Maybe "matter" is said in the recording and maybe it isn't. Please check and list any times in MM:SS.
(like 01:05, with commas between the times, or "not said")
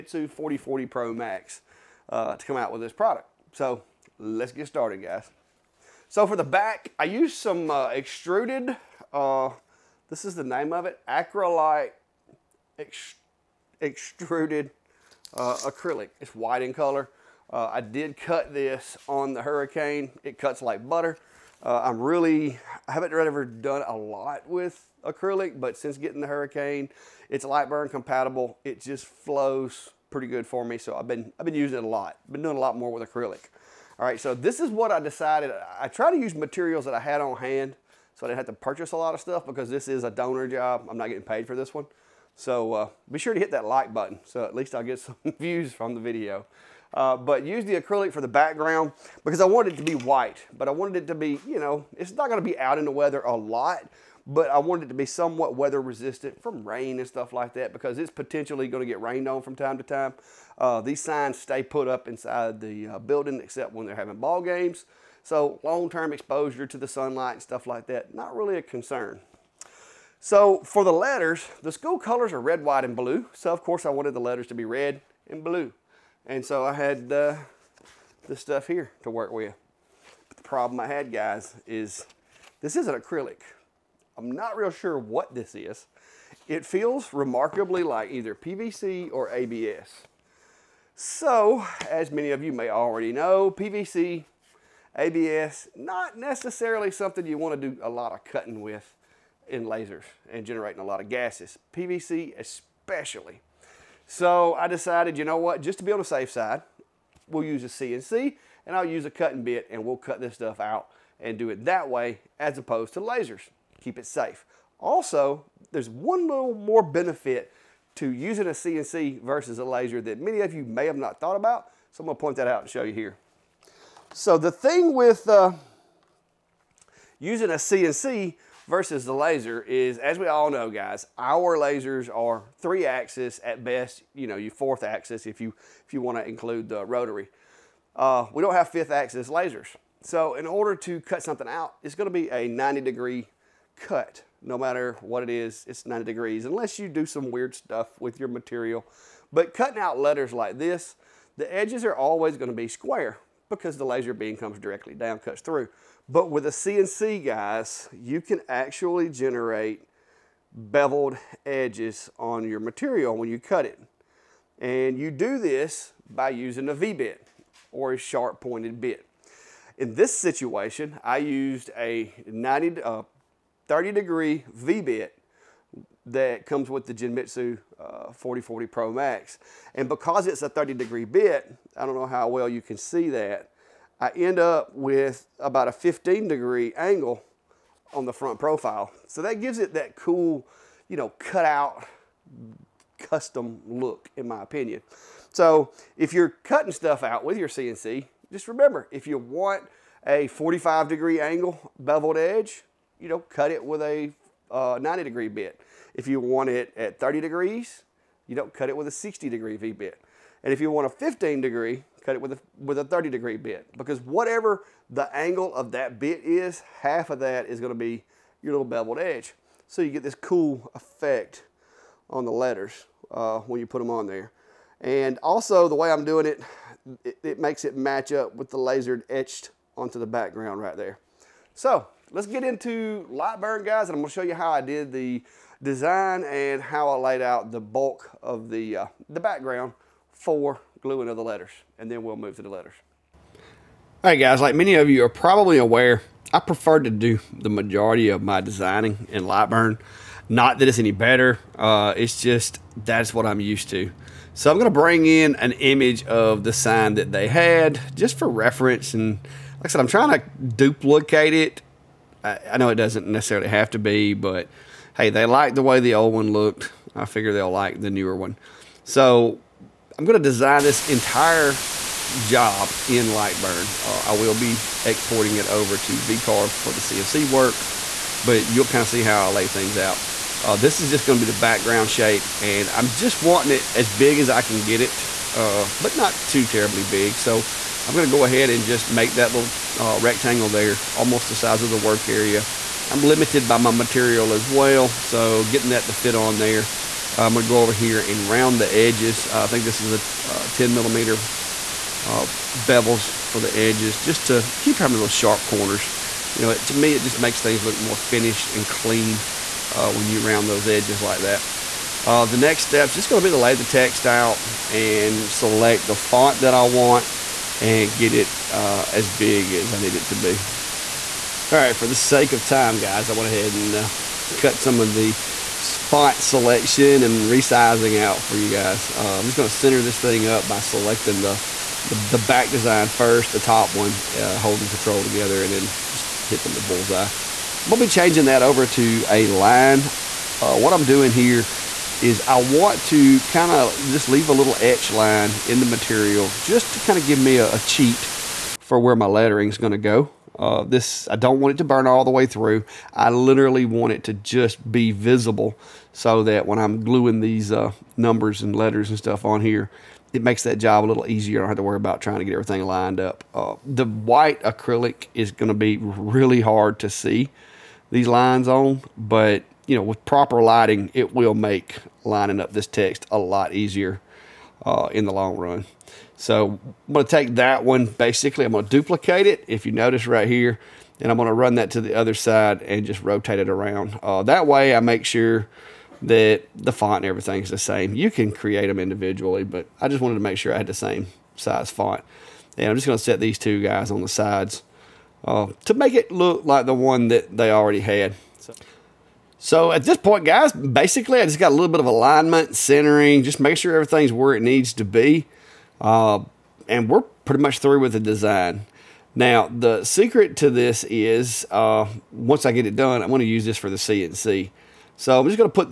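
02:24.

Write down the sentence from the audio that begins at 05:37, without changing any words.
We'll be changing that over to a line.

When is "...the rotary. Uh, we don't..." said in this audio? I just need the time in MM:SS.
02:16.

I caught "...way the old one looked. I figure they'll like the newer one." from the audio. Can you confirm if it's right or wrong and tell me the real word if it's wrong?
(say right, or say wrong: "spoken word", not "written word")
right.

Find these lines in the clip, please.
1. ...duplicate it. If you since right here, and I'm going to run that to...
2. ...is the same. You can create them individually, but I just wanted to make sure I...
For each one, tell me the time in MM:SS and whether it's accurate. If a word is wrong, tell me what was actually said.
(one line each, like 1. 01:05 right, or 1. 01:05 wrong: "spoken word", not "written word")
1. 06:18 wrong: "notice", not "since"
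2. 06:27 right.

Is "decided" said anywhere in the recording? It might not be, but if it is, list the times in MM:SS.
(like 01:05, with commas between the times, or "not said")
00:34, 01:44.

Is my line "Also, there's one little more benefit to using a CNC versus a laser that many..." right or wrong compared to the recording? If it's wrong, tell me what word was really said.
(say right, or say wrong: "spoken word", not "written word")
right.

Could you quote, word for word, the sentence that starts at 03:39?
So you get this cool effect on the letters uh, when you put them on there.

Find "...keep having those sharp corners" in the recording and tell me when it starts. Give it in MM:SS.
05:04.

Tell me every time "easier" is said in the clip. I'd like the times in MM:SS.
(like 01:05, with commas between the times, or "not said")
06:01, 06:13.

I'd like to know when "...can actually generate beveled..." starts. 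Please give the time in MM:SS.
02:38.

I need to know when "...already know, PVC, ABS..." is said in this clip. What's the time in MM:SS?
01:32.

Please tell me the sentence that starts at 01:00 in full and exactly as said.
Uh, these signs stay put up inside the uh, building except when they're having ball games.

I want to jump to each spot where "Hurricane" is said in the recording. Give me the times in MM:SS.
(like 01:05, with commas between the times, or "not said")
00:19, 00:26.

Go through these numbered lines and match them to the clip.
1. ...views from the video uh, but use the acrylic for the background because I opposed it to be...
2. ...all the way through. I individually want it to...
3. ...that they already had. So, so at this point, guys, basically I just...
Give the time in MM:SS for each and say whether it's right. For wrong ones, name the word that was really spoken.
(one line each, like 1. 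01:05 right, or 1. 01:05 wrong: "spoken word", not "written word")
1. 00:45 wrong: "wanted", not "opposed"
2. 05:51 wrong: "literally", not "individually"
3. 06:37 right.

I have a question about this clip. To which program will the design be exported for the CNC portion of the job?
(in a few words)
VCarve.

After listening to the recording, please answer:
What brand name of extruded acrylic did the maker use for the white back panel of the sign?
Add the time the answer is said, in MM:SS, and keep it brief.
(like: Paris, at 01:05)
Acrylite, at 00:11.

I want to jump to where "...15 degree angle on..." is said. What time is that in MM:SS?
03:05.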